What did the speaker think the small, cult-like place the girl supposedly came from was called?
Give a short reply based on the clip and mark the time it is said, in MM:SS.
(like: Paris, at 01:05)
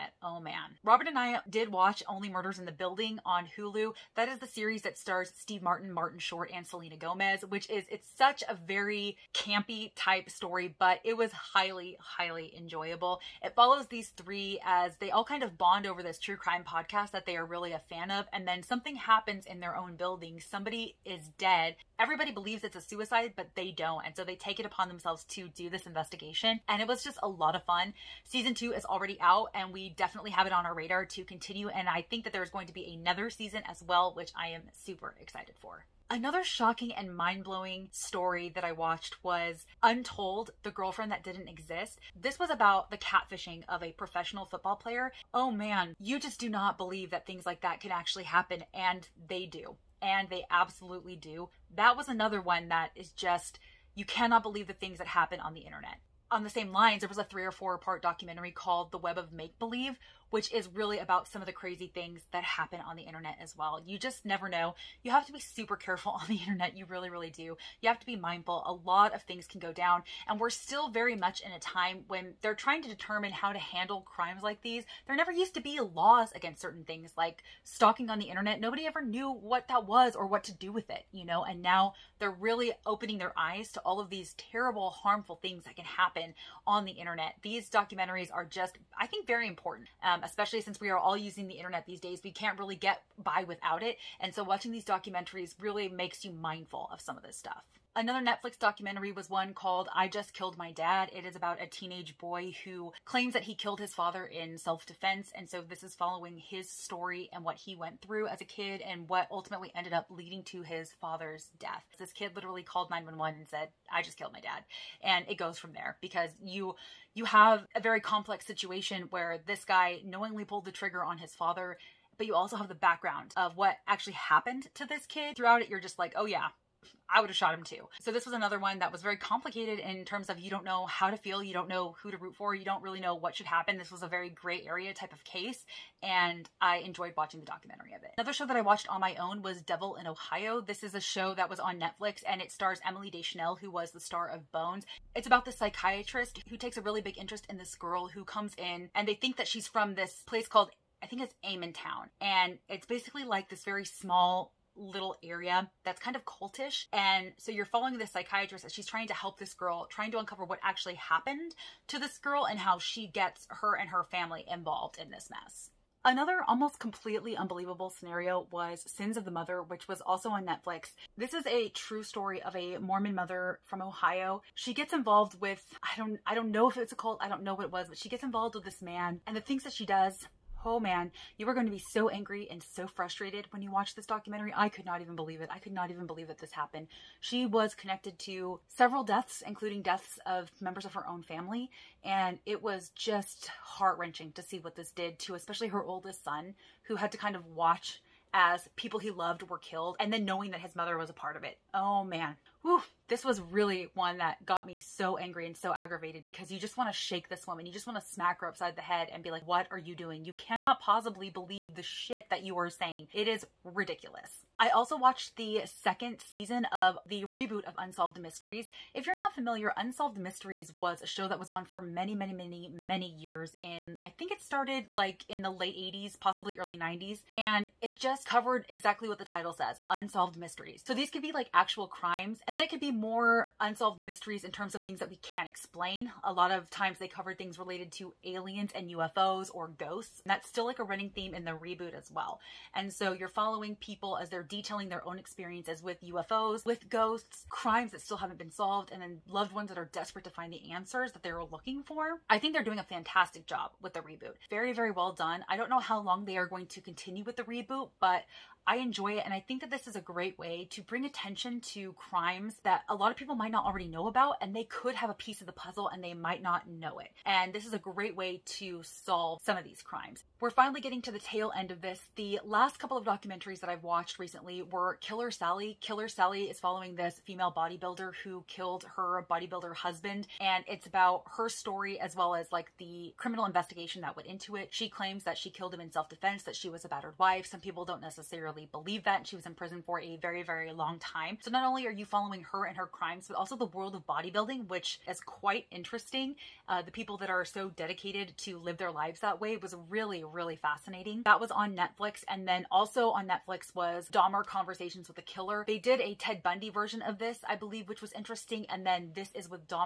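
Amon Town, at 02:31.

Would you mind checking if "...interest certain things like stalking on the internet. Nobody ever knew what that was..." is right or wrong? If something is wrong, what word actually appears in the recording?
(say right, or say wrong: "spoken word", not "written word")
wrong: "against", not "interest".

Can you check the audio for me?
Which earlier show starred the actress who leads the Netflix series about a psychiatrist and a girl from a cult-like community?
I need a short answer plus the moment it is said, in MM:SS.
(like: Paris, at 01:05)
Bones, at 02:24.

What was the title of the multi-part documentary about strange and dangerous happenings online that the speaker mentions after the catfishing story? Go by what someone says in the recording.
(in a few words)
The Web of Make Believe.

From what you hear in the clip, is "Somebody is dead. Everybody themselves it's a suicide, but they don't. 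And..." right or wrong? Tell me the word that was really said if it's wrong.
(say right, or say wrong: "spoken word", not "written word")
wrong: "believes", not "themselves".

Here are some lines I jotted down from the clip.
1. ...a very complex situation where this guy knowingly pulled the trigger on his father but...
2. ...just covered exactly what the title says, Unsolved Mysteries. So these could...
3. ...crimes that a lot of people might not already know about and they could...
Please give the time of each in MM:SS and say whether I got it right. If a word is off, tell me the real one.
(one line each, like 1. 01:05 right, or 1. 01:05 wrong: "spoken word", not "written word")
1. 01:57 right
2. 03:47 right
3. 04:21 right.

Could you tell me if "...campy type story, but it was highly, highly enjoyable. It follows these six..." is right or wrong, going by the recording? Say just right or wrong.
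wrong.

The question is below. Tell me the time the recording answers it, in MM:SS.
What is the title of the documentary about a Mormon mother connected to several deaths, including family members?
02:48.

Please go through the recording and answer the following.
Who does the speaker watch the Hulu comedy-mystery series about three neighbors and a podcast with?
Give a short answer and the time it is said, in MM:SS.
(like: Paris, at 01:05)
Robert, at 00:00.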